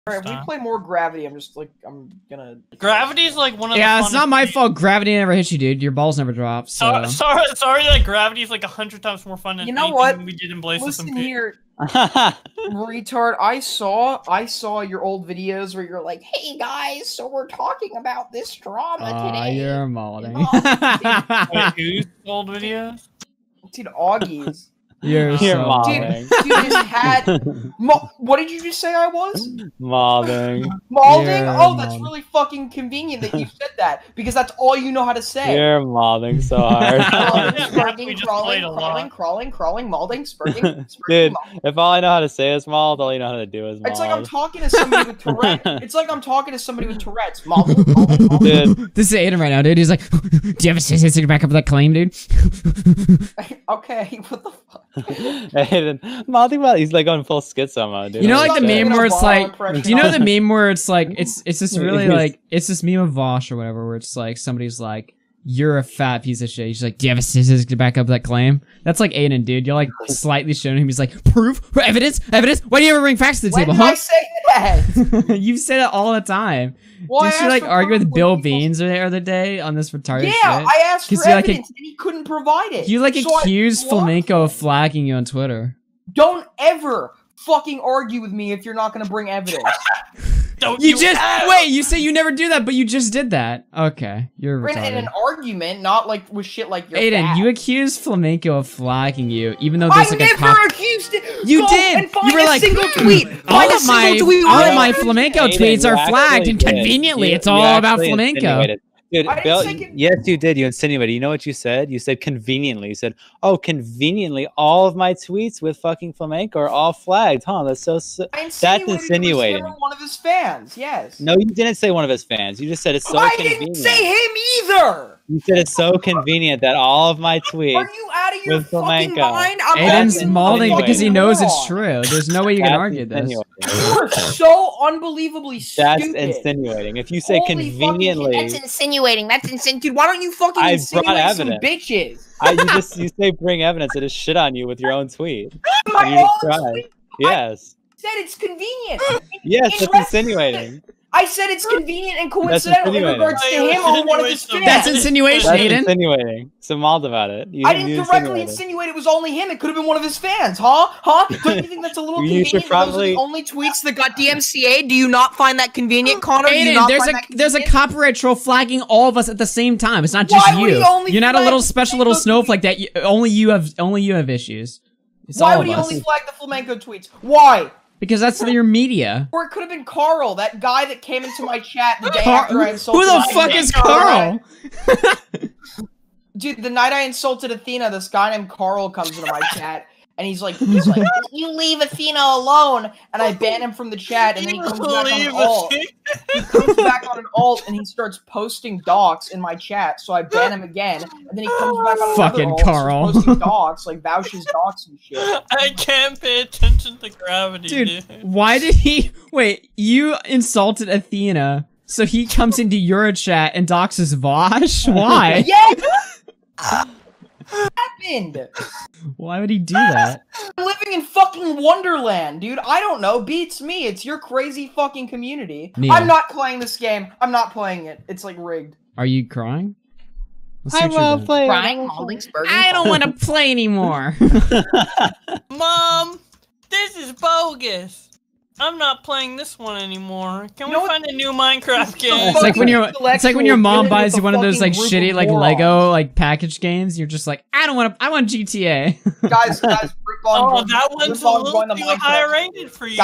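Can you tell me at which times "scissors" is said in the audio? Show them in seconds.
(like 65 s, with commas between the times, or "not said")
67 s.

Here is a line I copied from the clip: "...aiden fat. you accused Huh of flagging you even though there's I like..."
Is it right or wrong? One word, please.
wrong.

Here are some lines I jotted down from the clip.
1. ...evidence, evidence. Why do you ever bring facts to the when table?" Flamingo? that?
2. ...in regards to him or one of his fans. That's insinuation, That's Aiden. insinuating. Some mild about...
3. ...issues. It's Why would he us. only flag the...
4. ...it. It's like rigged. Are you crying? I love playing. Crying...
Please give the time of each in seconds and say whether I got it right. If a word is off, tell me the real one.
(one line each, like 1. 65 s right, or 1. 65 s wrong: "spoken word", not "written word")
1. 71 s wrong: "Huh", not "Flamingo"
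2. 152 s right
3. 174 s right
4. 227 s right.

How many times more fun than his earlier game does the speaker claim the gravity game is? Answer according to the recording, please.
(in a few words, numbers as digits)
100.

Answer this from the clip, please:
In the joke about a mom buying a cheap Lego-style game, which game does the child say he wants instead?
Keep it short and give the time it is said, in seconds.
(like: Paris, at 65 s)
GTA, at 248 s.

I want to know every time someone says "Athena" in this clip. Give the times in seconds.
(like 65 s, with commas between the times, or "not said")
187 s, 191 s, 210 s.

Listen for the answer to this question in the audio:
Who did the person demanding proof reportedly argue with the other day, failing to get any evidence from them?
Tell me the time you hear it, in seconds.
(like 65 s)
78 s.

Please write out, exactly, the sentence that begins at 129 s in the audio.
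I'm Aiden's mauling because he knows it's true.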